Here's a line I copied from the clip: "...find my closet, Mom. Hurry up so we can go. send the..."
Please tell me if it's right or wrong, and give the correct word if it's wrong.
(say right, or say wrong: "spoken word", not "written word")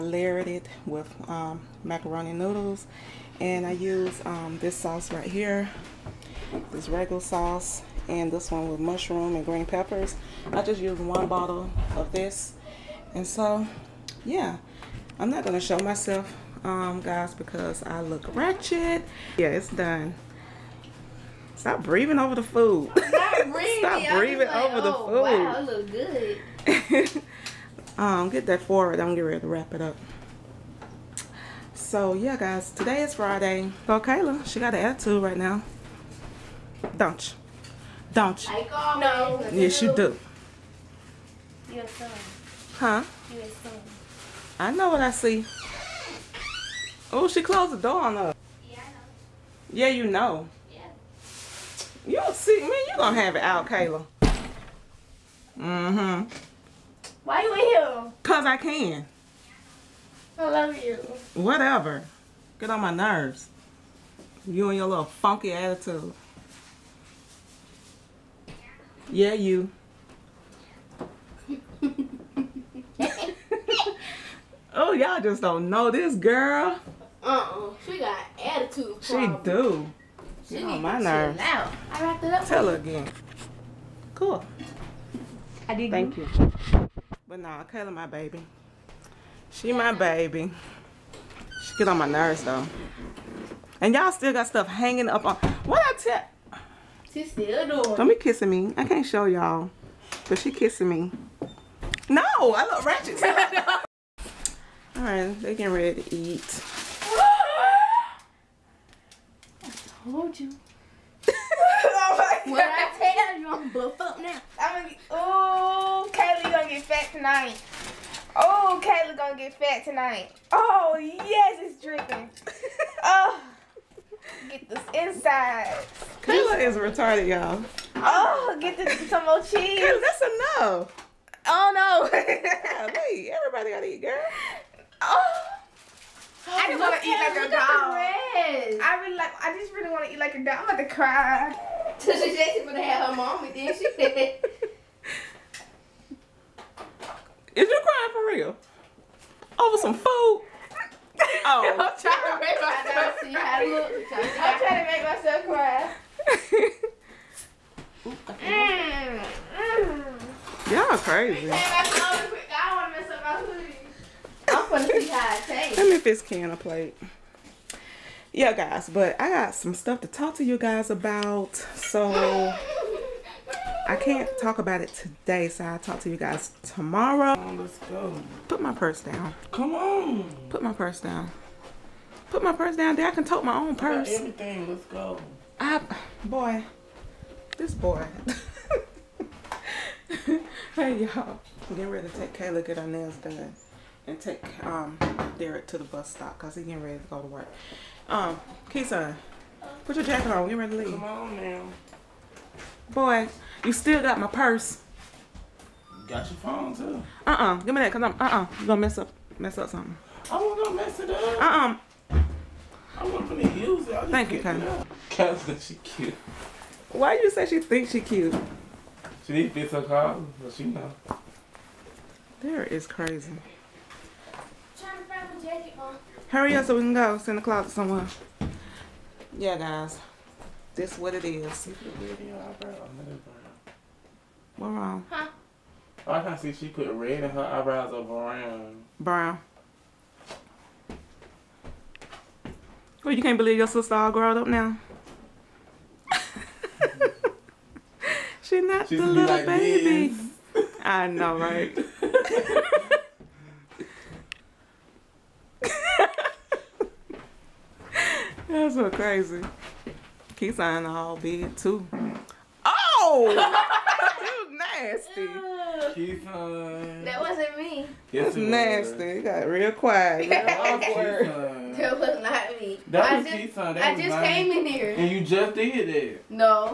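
wrong: "jacket", not "closet".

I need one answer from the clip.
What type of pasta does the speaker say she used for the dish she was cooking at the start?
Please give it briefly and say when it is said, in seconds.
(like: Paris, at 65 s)
Macaroni noodles, at 1 s.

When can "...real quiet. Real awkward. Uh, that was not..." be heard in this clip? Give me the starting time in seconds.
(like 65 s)
269 s.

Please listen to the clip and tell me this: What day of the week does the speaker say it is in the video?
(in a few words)
Friday.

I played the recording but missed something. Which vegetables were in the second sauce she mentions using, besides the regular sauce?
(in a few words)
Mushroom and green peppers.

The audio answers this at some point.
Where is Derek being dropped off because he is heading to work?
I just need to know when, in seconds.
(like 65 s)
195 s.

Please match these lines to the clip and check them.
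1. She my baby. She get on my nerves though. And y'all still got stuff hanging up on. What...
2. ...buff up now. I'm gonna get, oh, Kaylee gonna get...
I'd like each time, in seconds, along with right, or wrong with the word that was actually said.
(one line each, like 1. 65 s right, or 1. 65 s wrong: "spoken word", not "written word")
1. 89 s right
2. 113 s right.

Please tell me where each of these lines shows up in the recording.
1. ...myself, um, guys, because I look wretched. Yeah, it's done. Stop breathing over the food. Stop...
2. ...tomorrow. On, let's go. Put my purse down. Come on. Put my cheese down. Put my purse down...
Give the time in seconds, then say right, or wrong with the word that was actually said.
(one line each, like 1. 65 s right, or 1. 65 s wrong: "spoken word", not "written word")
1. 15 s right
2. 176 s wrong: "purse", not "cheese".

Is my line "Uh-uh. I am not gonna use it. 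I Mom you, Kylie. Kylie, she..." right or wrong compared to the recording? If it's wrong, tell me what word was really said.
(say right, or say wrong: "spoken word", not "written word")
wrong: "Thank", not "Mom".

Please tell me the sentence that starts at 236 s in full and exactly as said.
Oh, I can see she put red in her eyebrows or brown.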